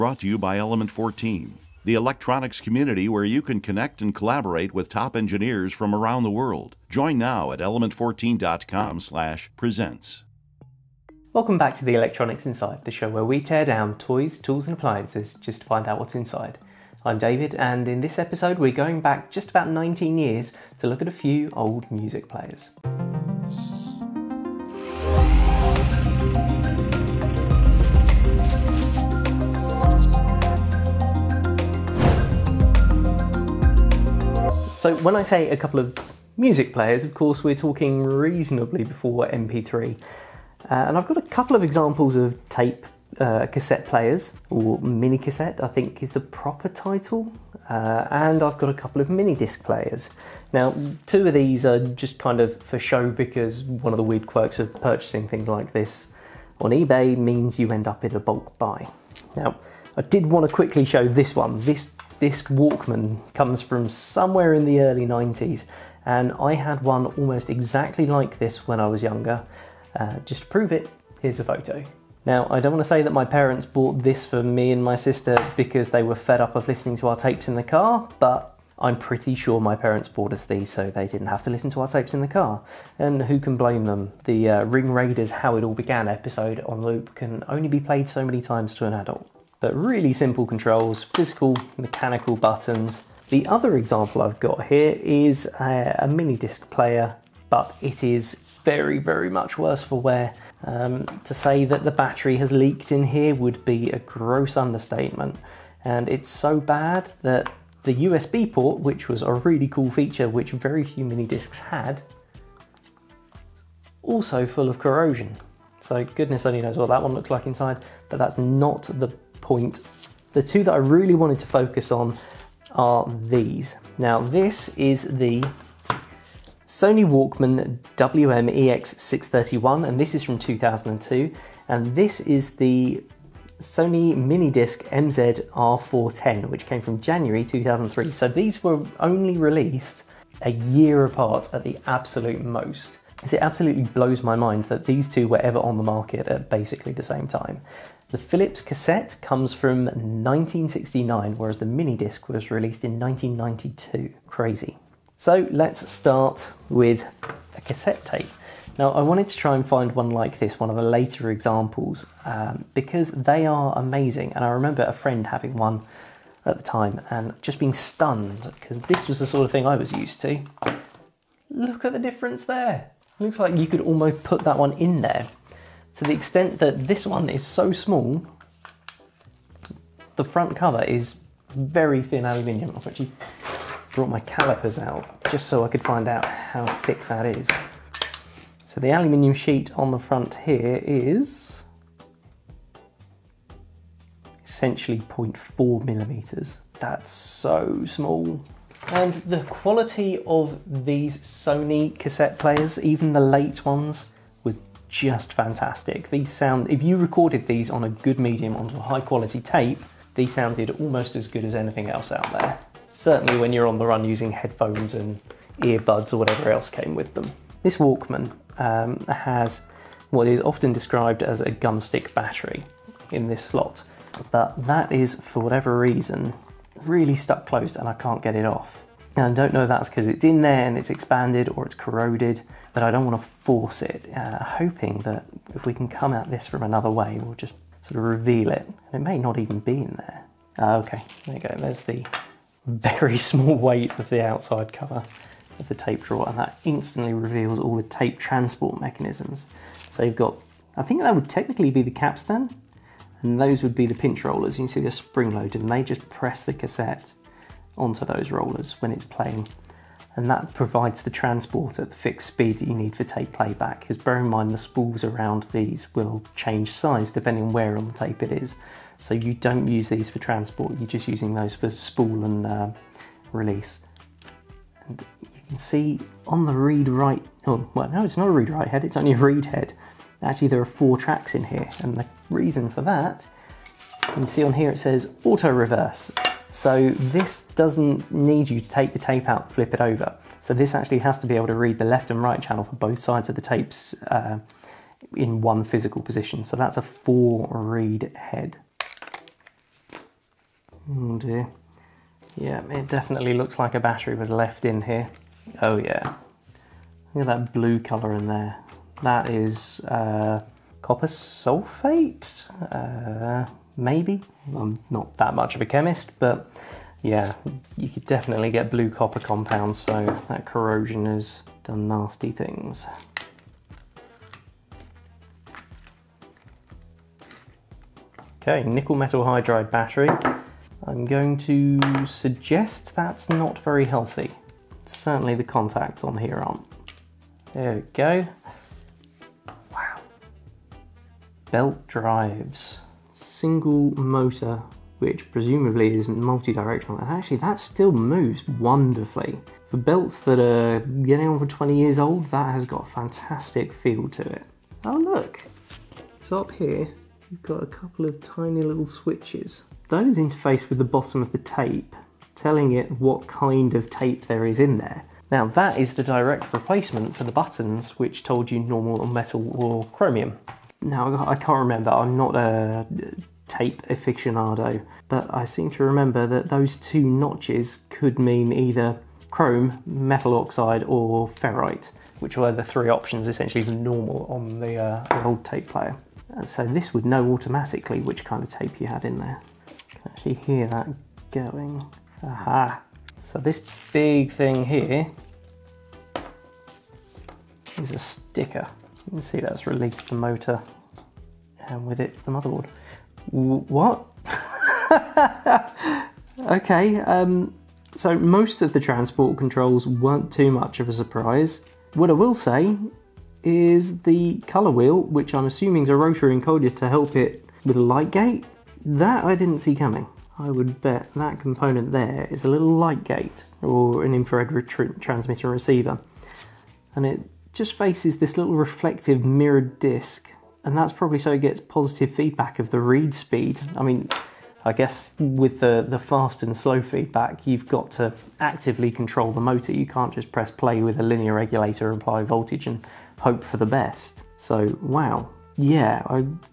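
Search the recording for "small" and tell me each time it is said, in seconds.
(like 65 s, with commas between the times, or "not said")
177 s, 197 s, 243 s.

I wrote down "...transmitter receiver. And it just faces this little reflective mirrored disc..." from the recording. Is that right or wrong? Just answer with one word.
right.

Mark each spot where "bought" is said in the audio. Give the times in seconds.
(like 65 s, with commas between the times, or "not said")
73 s, 80 s.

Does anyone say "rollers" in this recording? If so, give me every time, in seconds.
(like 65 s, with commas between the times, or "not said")
254 s, 258 s.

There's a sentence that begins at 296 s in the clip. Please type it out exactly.
So that's a four read head.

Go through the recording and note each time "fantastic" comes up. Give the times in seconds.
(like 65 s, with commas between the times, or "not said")
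205 s, 352 s.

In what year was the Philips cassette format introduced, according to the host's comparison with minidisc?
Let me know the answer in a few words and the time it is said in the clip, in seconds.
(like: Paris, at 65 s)
1969, at 149 s.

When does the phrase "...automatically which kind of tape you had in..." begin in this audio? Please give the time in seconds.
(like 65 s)
387 s.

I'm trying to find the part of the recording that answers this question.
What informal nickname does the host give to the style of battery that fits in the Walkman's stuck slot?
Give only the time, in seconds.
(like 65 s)
221 s.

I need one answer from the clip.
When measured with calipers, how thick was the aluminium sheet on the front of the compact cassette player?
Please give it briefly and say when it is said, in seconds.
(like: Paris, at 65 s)
0.4 millimeters, at 194 s.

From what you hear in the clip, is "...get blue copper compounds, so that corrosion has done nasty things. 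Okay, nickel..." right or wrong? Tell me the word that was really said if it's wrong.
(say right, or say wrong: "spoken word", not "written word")
right.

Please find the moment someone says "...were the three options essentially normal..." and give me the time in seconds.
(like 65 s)
382 s.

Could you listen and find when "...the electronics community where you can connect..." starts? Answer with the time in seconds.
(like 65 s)
1 s.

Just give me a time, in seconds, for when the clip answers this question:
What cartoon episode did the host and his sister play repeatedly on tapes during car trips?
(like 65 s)
84 s.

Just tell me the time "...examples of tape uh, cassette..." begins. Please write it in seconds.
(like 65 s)
41 s.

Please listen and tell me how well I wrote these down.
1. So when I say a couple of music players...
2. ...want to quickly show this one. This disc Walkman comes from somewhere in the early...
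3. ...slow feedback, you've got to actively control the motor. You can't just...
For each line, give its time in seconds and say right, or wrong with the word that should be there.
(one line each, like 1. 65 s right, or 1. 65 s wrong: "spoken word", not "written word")
1. 34 s right
2. 60 s right
3. 436 s right.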